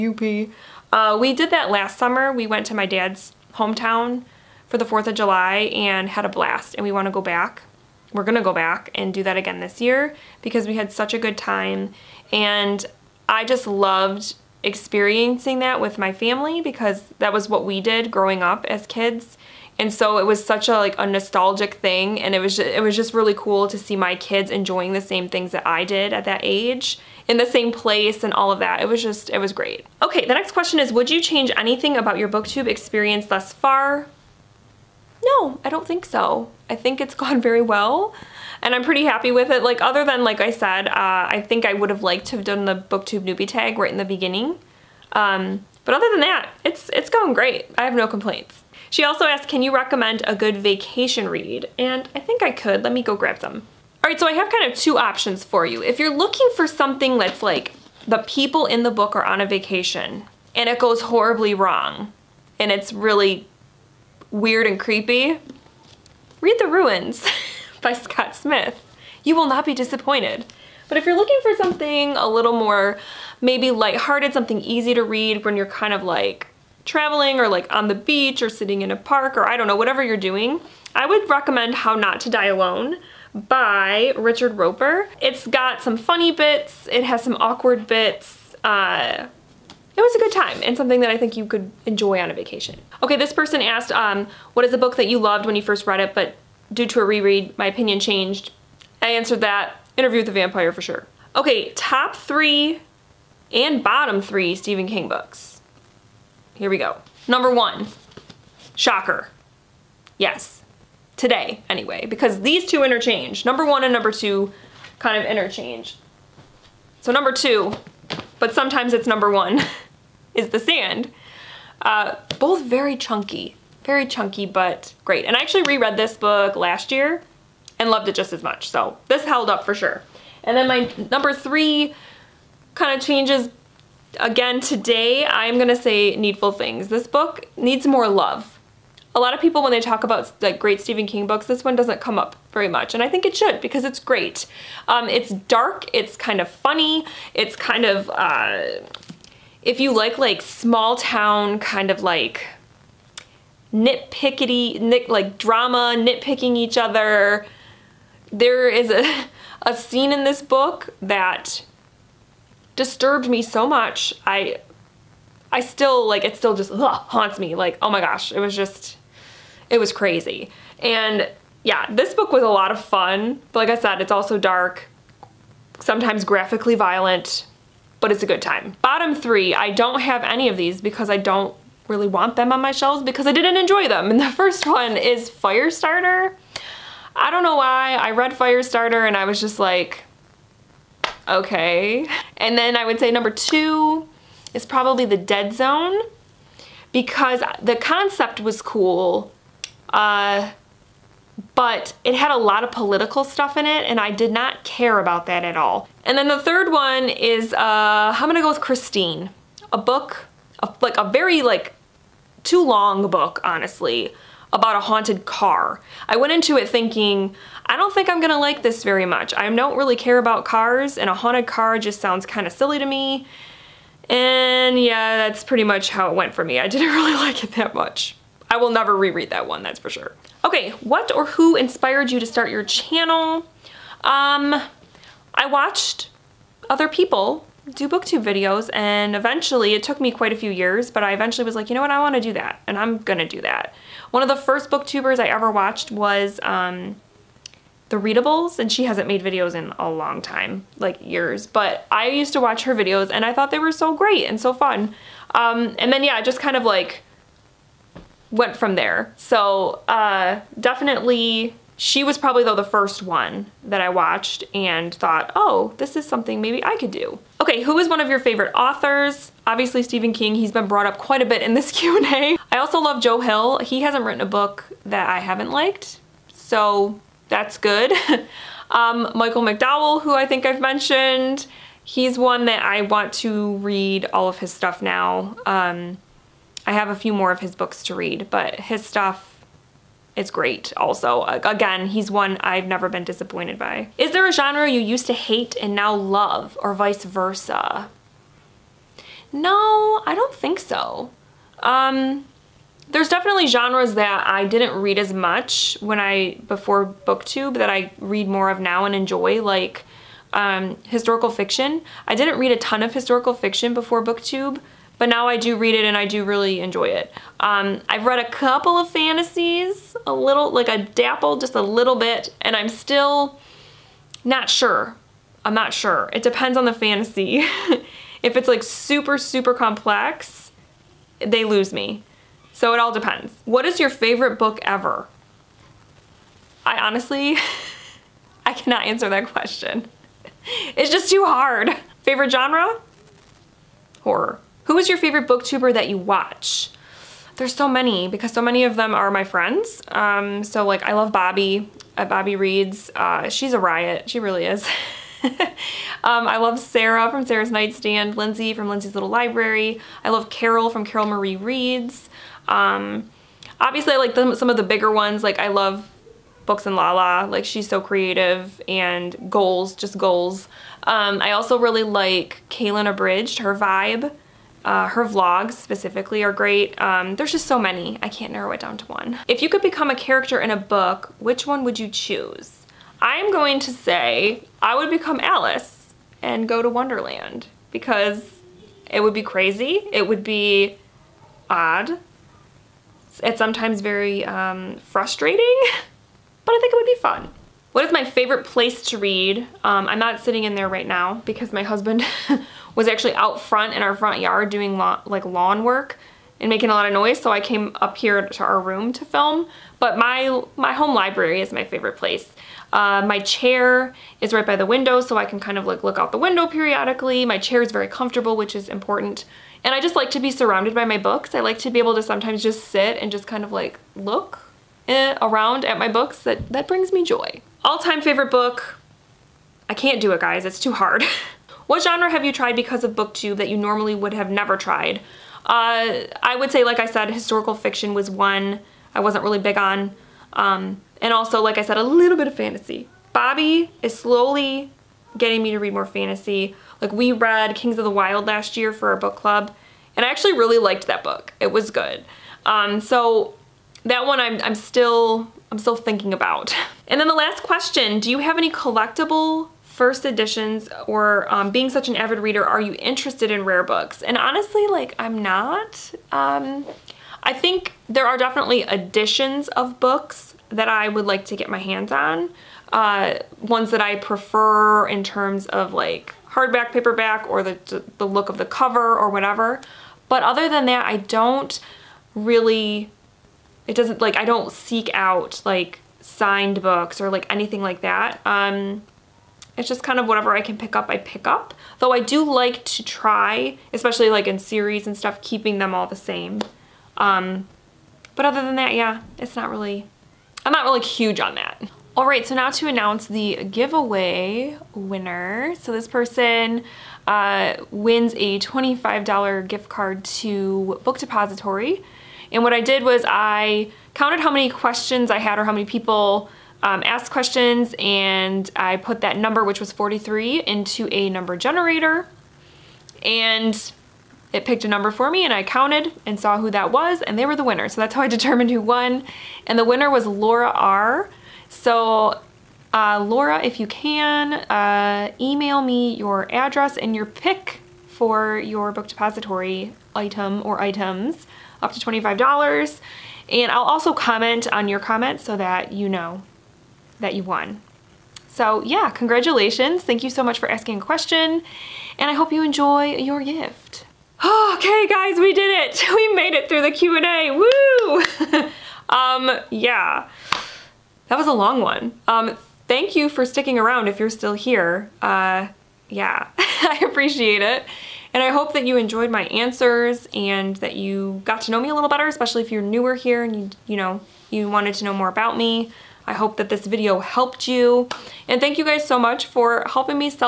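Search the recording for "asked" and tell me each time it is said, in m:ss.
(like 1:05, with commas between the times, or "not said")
0:49, 1:33, 8:36.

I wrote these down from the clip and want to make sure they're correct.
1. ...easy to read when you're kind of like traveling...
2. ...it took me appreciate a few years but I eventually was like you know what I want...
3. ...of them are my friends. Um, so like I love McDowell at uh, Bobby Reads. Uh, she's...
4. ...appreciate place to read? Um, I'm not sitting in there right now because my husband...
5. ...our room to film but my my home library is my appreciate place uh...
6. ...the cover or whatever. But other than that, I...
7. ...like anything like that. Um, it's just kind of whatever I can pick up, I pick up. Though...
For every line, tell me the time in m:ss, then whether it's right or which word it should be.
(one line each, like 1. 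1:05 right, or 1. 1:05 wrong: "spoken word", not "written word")
1. 1:14 right
2. 3:59 wrong: "quite", not "appreciate"
3. 5:48 wrong: "Bobby", not "McDowell"
4. 6:38 wrong: "favorite", not "appreciate"
5. 6:48 wrong: "favorite", not "appreciate"
6. 7:58 right
7. 8:07 right.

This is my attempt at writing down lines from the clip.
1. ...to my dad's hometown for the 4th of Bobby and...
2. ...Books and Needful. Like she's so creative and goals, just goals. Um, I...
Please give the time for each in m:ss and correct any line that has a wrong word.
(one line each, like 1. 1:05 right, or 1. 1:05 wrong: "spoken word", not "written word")
1. 0:02 wrong: "July", not "Bobby"
2. 6:06 wrong: "Lala", not "Needful".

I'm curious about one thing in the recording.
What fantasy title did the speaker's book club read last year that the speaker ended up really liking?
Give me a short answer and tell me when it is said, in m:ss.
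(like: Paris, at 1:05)
Kings of the Wyld, at 7:27.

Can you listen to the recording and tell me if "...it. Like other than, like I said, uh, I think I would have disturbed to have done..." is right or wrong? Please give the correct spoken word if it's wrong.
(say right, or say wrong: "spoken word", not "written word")
wrong: "liked", not "disturbed".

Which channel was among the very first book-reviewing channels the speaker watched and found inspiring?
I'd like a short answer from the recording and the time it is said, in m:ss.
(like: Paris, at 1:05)
The Readables, at 4:07.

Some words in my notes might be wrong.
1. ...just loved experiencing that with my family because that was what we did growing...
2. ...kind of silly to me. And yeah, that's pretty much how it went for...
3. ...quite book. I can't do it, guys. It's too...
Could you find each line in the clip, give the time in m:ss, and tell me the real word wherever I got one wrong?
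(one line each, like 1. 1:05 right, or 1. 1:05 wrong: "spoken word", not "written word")
1. 0:13 right
2. 3:42 right
3. 7:07 wrong: "favorite", not "quite".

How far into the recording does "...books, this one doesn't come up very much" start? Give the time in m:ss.
2:21.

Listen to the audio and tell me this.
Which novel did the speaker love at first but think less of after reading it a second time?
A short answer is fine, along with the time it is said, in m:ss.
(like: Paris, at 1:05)
Interview with the Vampire, at 1:39.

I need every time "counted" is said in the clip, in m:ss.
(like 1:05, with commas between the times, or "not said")
8:33, 8:45.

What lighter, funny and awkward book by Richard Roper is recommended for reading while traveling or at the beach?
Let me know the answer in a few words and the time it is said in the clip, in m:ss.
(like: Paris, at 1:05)
How Not to Die Alone, at 1:21.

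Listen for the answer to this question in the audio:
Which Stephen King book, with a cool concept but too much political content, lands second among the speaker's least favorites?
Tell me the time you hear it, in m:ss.
3:15.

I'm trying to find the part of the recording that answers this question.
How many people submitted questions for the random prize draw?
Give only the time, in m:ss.
8:39.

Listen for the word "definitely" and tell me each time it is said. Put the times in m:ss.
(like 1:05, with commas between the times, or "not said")
4:20, 5:03, 7:48.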